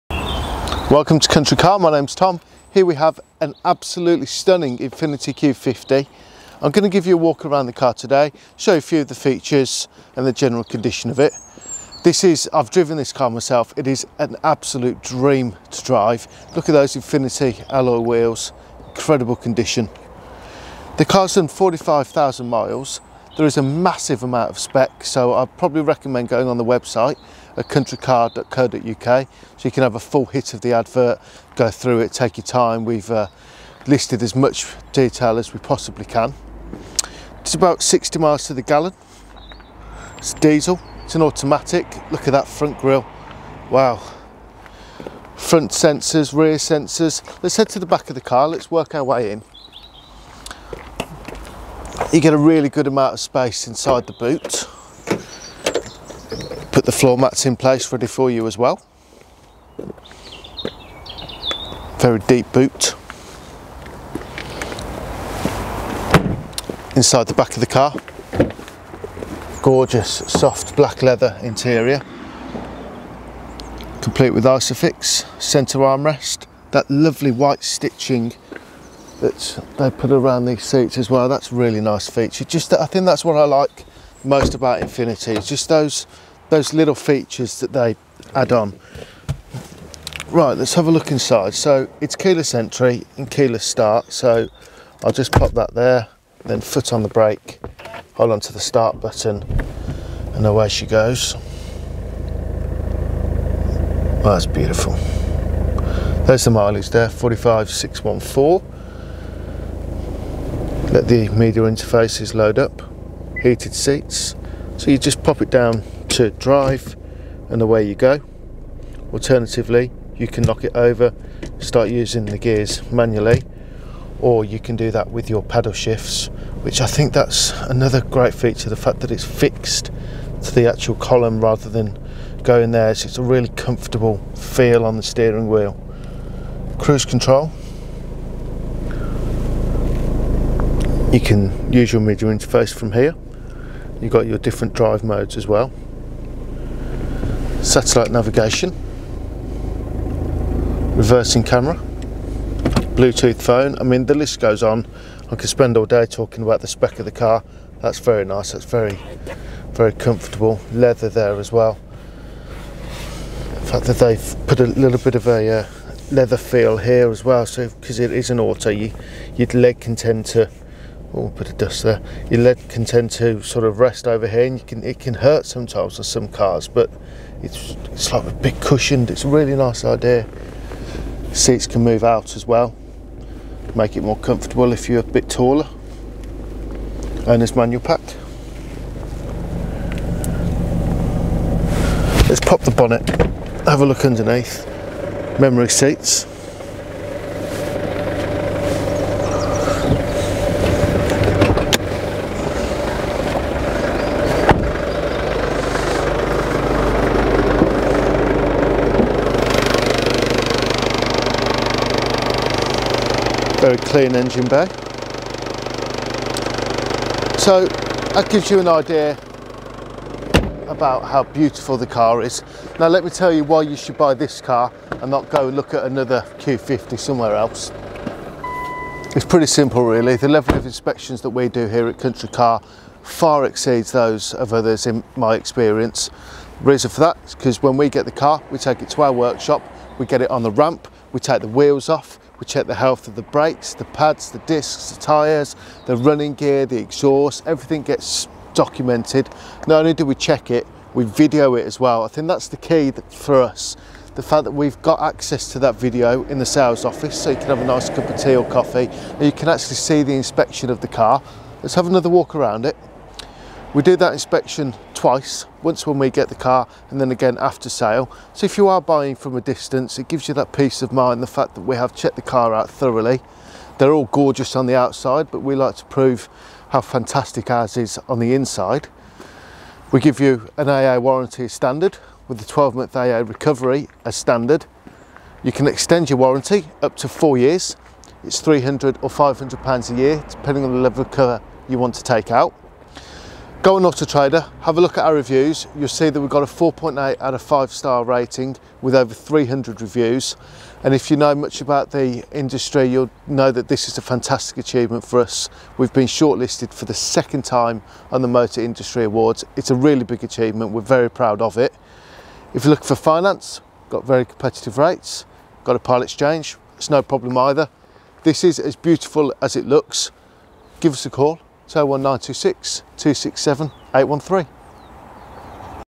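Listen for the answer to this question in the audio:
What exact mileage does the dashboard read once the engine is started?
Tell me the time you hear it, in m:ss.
1:47.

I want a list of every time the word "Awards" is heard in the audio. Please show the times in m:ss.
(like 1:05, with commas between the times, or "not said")
5:09.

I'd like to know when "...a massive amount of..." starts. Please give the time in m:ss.
0:23.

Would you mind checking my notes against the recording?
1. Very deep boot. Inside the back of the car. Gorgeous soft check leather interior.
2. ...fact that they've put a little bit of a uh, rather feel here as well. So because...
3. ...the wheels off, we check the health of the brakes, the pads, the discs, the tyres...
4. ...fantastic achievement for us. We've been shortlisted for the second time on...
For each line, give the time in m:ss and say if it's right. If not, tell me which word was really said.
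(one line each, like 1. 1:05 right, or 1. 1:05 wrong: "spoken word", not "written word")
1. 1:01 wrong: "black", not "check"
2. 2:43 wrong: "leather", not "rather"
3. 4:01 right
4. 5:04 right.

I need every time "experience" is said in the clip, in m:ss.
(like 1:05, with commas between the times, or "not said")
3:55.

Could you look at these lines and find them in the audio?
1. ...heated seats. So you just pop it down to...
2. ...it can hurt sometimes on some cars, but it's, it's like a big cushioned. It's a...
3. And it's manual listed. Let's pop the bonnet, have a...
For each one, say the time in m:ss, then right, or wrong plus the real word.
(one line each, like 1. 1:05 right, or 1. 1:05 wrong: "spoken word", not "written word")
1. 1:53 right
2. 2:54 right
3. 3:07 wrong: "packed", not "listed".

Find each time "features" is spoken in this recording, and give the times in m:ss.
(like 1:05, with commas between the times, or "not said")
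0:09, 1:22, 1:26, 2:08.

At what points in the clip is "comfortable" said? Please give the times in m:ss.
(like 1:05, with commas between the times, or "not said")
2:13, 2:39, 3:04.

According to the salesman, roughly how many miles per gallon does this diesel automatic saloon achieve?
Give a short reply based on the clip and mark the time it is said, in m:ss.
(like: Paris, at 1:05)
60, at 0:37.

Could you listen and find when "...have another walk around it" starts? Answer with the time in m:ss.
4:21.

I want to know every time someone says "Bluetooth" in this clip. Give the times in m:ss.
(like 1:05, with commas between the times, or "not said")
2:32.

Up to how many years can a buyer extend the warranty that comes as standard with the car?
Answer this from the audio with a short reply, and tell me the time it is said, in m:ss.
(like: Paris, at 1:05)
4 years, at 4:47.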